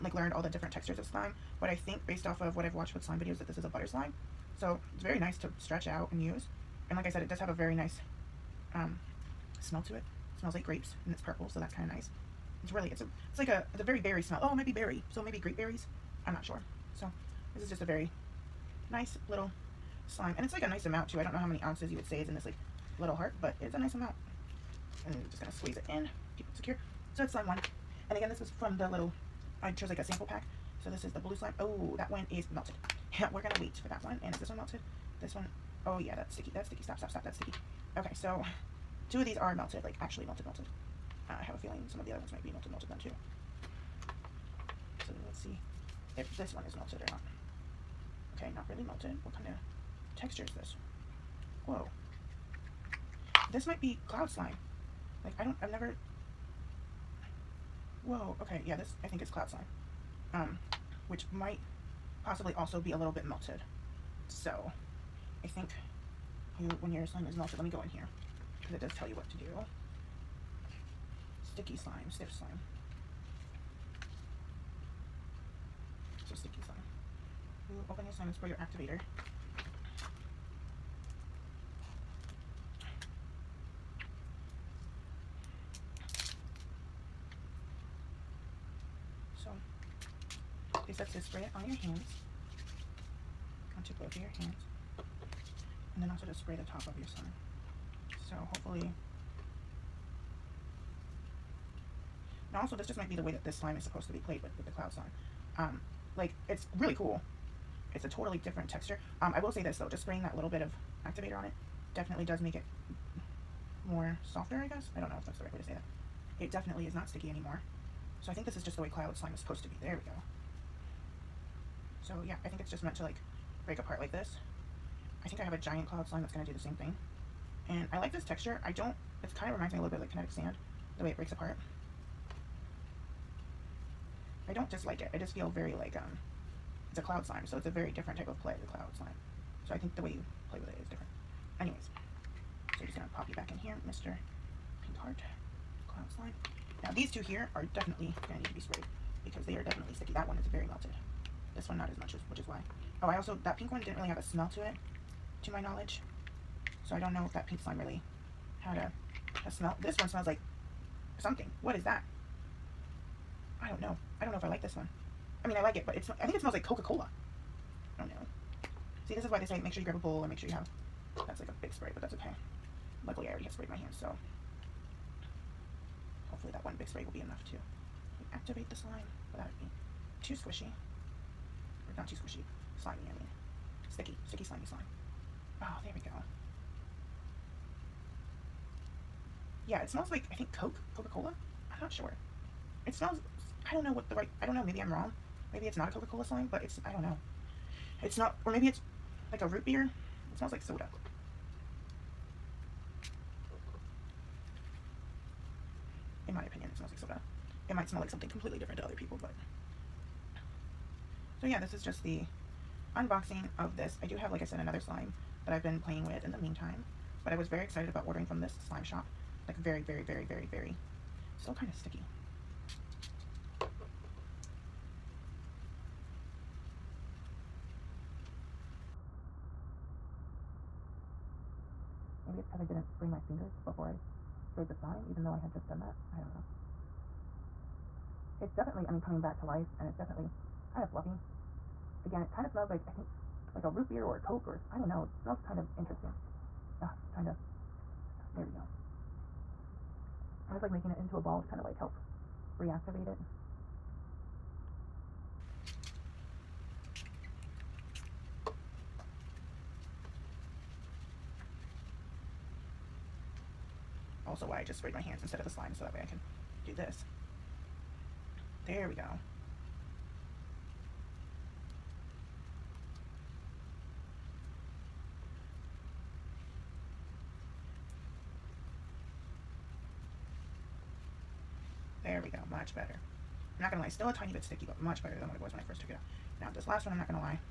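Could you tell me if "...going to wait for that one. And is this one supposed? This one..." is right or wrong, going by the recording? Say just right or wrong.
wrong.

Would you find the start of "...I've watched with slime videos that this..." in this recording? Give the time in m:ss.
0:02.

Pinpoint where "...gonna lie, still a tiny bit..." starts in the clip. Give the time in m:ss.
4:43.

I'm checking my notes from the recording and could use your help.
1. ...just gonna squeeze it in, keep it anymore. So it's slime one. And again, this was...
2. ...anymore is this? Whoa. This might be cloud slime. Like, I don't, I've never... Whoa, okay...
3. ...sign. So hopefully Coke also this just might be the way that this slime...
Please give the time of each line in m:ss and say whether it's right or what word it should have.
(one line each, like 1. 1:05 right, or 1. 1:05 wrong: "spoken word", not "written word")
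1. 0:25 wrong: "secure", not "anymore"
2. 0:50 wrong: "texture", not "anymore"
3. 1:37 wrong: "Now", not "Coke".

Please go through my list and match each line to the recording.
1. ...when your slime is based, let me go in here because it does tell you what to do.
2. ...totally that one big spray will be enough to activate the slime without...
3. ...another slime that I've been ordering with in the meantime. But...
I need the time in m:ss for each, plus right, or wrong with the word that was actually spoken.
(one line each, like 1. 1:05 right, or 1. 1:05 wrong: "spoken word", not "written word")
1. 1:06 wrong: "melted", not "based"
2. 2:56 wrong: "hopefully", not "totally"
3. 3:34 wrong: "playing", not "ordering".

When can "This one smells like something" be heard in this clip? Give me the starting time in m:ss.
2:39.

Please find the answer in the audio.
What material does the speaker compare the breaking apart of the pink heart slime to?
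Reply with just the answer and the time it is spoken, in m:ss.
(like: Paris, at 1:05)
kinetic sand, at 2:10.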